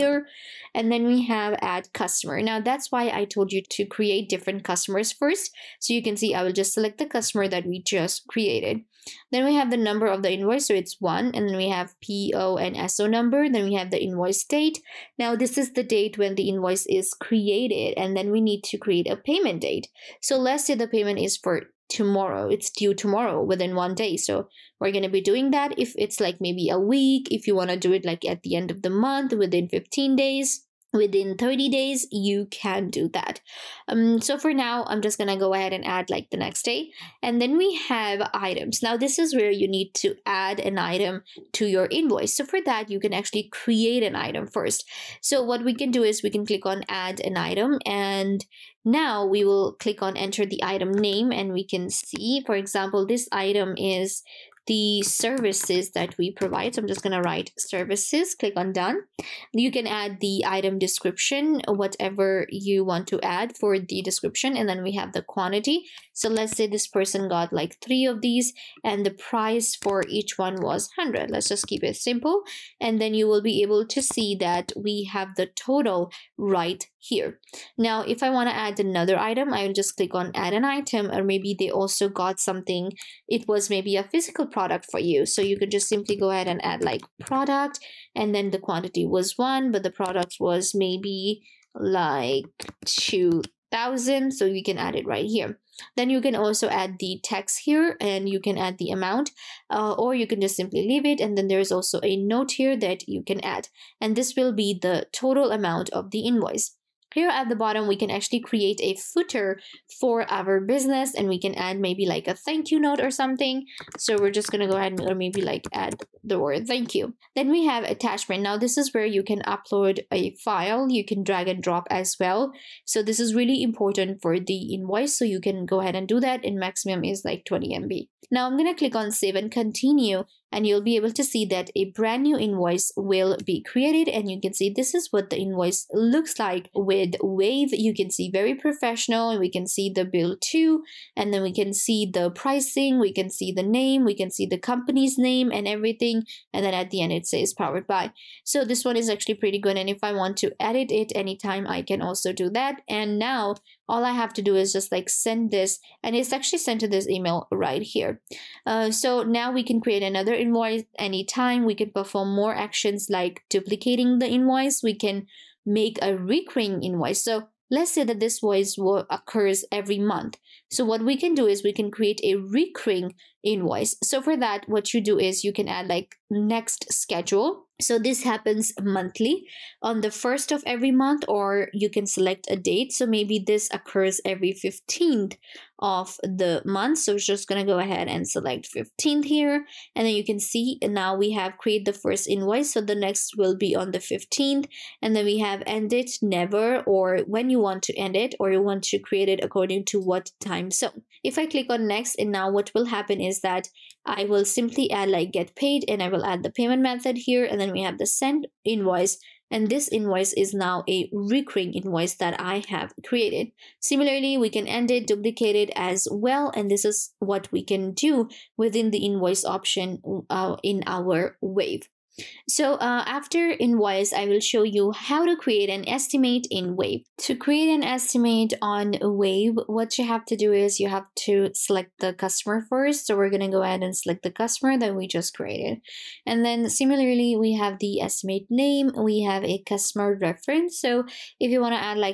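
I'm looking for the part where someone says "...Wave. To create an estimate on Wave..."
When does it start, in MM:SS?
03:46.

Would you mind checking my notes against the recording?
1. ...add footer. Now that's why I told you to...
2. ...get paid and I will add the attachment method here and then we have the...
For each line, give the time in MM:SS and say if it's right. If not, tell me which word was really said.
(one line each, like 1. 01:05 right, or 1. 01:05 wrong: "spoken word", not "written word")
1. 00:01 wrong: "customer", not "footer"
2. 03:25 wrong: "payment", not "attachment".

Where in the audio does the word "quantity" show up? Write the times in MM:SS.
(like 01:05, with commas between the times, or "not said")
01:05, 01:28.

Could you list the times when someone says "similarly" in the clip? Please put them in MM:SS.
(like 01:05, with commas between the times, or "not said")
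03:33, 03:56.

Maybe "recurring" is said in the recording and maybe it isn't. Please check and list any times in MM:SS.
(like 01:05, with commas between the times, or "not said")
02:46, 02:52, 03:31.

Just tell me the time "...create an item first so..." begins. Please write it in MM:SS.
00:43.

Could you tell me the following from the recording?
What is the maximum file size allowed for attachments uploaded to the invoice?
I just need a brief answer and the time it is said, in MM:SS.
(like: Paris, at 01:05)
20 MB, at 02:07.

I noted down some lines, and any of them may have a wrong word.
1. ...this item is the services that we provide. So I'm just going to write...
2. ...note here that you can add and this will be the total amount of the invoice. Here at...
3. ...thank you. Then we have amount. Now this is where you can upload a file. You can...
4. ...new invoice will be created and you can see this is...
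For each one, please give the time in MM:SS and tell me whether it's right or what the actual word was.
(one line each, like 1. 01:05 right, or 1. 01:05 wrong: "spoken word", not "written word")
1. 00:53 right
2. 01:42 right
3. 01:56 wrong: "attachment", not "amount"
4. 02:12 right.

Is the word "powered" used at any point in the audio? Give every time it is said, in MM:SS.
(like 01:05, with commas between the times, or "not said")
02:27.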